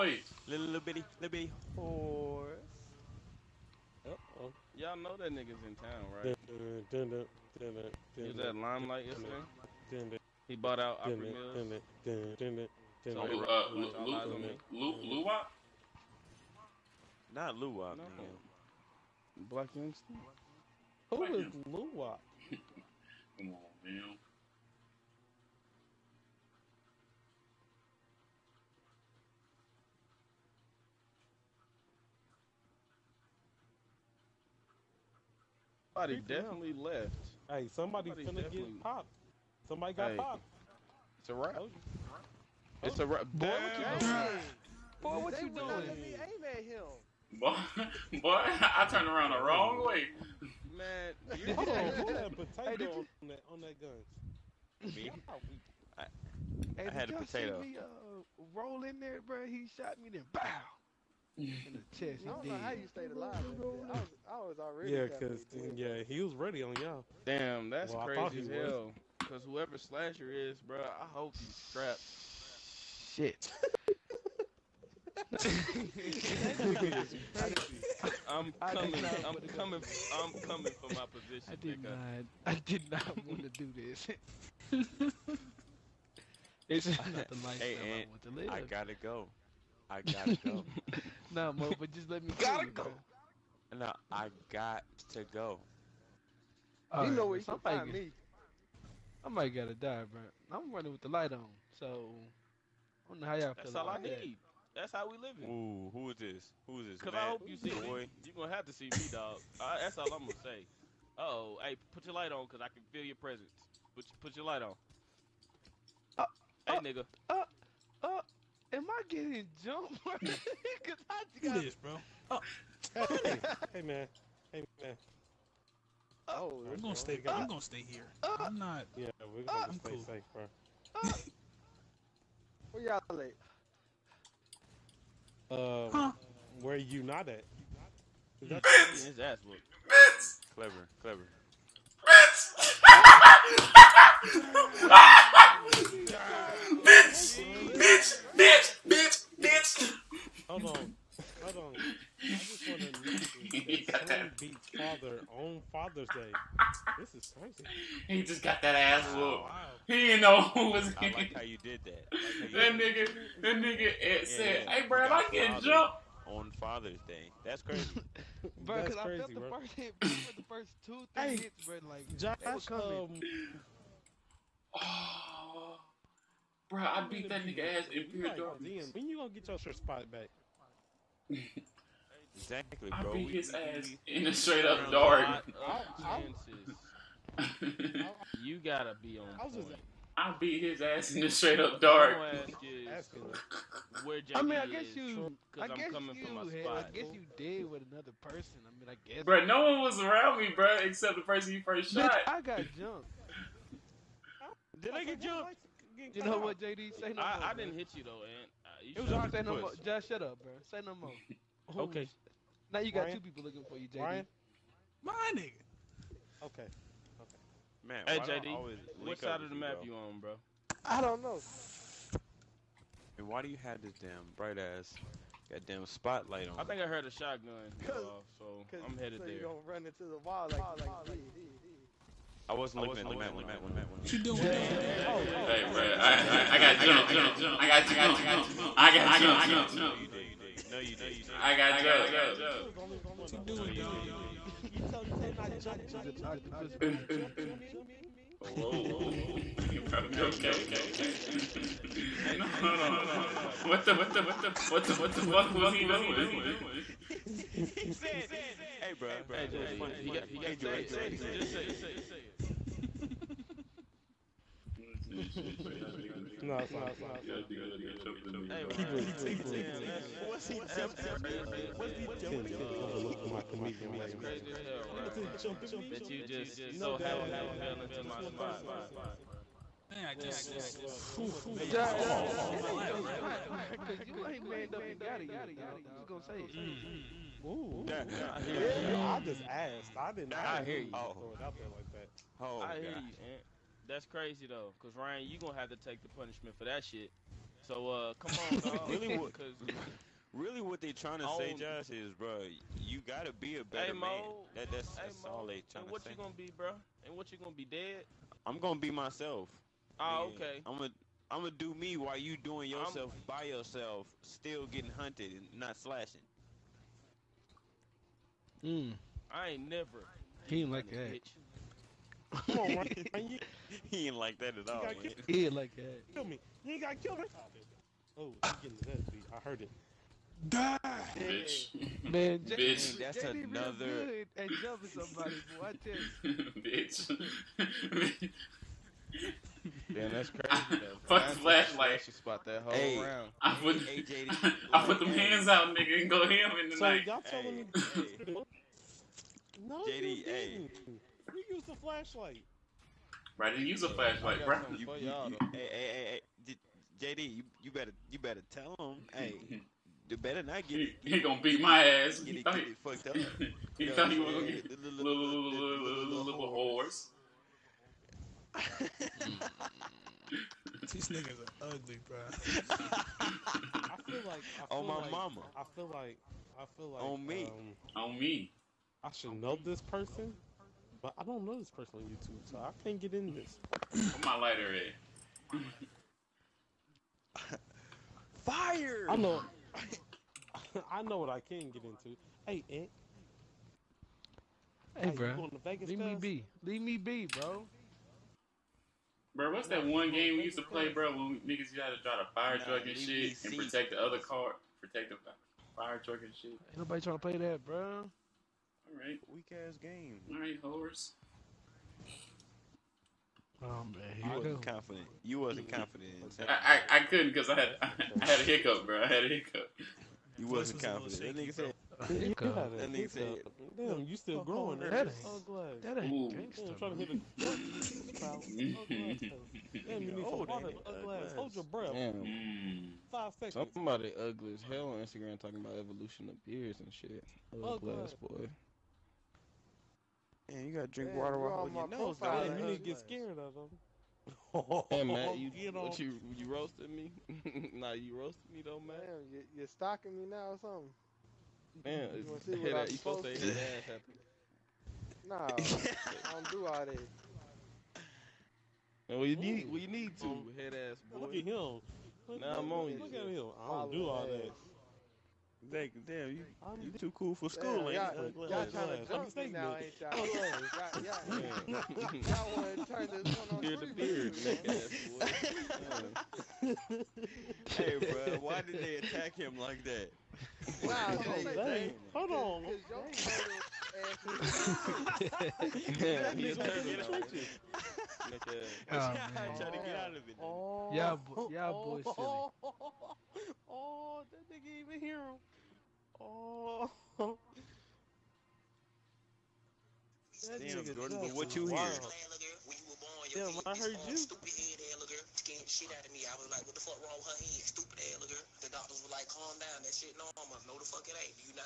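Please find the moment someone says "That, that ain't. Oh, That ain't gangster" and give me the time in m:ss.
7:04.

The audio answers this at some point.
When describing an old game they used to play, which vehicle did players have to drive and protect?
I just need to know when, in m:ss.
6:45.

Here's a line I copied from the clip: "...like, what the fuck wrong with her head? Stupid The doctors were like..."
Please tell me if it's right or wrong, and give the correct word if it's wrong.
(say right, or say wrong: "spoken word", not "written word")
right.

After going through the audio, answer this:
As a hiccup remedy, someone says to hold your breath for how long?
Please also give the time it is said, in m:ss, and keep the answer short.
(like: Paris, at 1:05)
5 seconds, at 7:13.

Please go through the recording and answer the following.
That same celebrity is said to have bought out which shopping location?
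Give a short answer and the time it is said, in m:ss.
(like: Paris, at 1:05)
Opry Mills, at 0:11.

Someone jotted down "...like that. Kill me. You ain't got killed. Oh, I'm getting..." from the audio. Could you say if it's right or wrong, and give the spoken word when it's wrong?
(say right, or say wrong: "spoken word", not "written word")
right.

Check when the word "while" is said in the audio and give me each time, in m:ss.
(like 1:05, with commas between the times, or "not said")
5:11, 7:21.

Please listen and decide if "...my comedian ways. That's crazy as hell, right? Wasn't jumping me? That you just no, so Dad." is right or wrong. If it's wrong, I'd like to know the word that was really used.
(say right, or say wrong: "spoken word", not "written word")
right.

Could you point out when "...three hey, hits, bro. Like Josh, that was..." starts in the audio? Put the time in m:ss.
2:51.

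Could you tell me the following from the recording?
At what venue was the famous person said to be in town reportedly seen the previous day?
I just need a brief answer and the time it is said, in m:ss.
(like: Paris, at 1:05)
Limelight, at 0:08.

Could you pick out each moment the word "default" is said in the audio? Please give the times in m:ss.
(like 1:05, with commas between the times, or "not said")
not said.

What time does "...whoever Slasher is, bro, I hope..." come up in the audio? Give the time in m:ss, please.
1:09.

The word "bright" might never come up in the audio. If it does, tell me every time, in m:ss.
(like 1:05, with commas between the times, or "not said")
3:44.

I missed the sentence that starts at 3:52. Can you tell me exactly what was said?
I wasn't looking at the mat when I was running.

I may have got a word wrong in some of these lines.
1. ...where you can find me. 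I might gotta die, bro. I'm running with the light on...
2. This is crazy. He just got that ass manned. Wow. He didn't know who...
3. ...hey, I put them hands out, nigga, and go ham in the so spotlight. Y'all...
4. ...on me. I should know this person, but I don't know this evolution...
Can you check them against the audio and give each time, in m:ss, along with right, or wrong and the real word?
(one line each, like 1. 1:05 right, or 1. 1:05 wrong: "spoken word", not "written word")
1. 1:37 right
2. 2:36 wrong: "whooped", not "manned"
3. 5:43 wrong: "night", not "spotlight"
4. 6:18 wrong: "person", not "evolution".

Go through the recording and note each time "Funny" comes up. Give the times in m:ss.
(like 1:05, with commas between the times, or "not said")
4:19.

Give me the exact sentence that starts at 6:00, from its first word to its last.
You better not get He, he gonna beat my ass.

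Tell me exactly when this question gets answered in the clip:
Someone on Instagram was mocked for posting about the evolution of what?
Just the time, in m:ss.
7:16.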